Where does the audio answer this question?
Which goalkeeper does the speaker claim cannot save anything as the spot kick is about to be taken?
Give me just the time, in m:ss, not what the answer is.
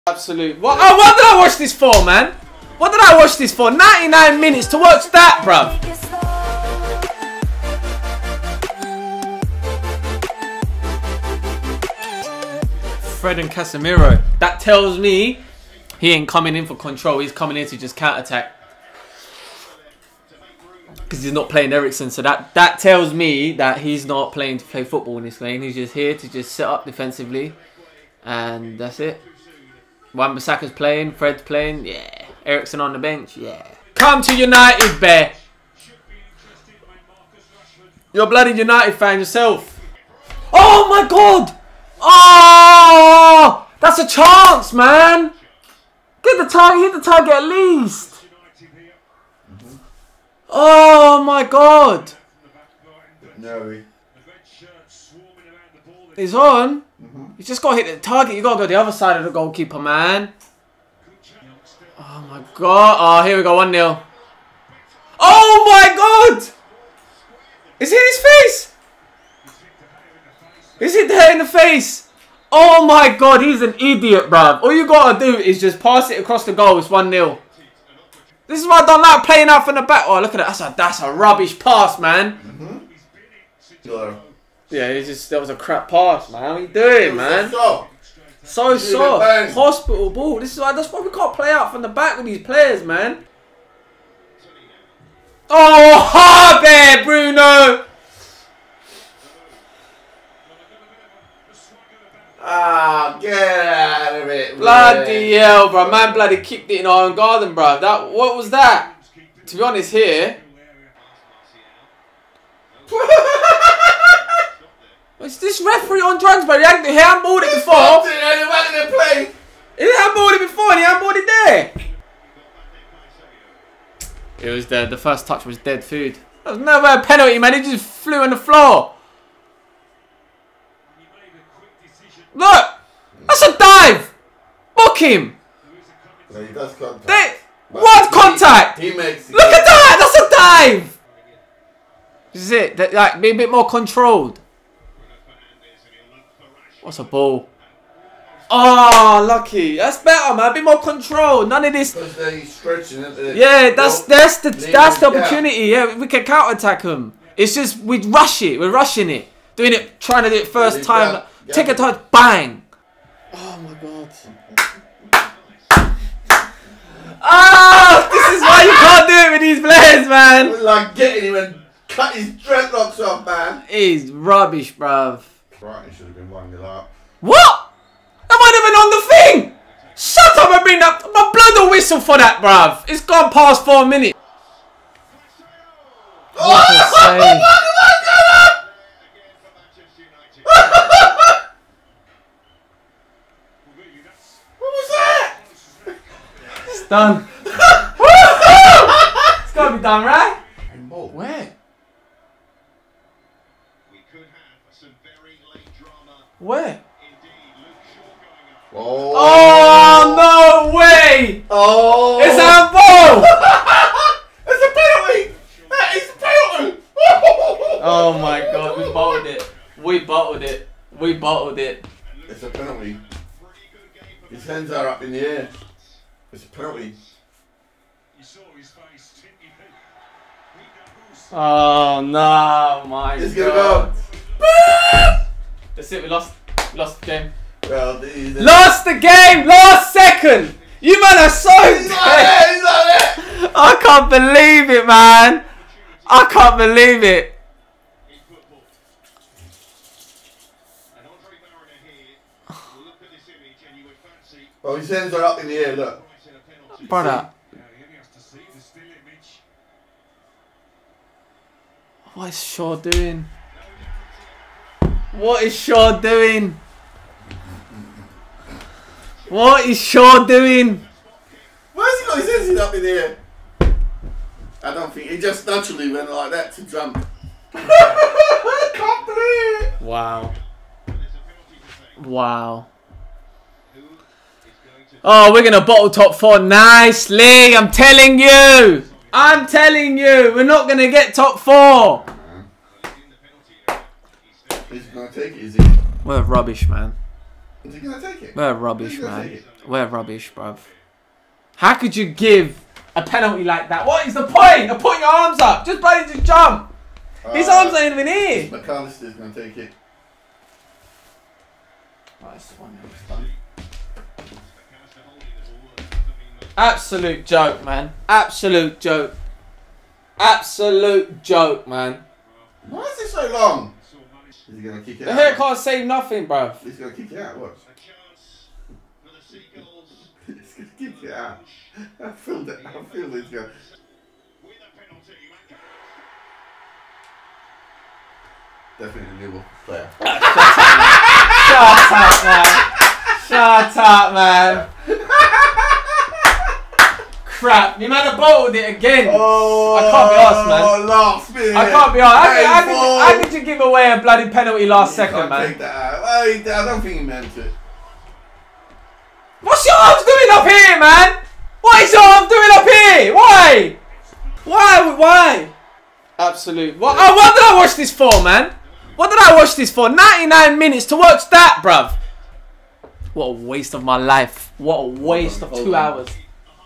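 5:25.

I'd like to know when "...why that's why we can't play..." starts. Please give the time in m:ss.
1:30.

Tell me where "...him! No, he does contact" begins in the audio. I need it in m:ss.
2:14.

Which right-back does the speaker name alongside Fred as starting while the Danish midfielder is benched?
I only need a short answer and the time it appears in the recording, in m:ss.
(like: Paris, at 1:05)
Wan-Bissaka, at 0:30.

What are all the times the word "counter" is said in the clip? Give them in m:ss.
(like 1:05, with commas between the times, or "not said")
0:17, 2:36.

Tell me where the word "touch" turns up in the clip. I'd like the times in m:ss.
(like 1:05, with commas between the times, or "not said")
2:05, 2:41.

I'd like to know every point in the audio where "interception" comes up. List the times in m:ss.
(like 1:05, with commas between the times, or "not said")
not said.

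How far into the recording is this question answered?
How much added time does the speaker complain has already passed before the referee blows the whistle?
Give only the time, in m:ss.
3:03.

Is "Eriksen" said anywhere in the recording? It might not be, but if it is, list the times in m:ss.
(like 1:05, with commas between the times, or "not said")
0:21, 0:32.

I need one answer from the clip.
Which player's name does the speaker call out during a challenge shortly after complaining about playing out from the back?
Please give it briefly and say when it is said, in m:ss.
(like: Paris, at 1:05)
Bruno, at 1:37.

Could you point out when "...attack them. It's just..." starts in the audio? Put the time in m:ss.
2:36.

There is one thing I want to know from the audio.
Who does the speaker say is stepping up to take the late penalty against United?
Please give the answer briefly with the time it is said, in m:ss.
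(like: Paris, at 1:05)
Mac Allister, at 5:08.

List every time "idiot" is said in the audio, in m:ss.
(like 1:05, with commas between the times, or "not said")
1:13.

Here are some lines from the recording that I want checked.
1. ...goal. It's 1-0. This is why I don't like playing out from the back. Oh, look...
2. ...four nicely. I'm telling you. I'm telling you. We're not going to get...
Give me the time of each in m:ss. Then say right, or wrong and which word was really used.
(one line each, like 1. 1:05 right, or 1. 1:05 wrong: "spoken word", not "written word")
1. 1:16 right
2. 4:46 right.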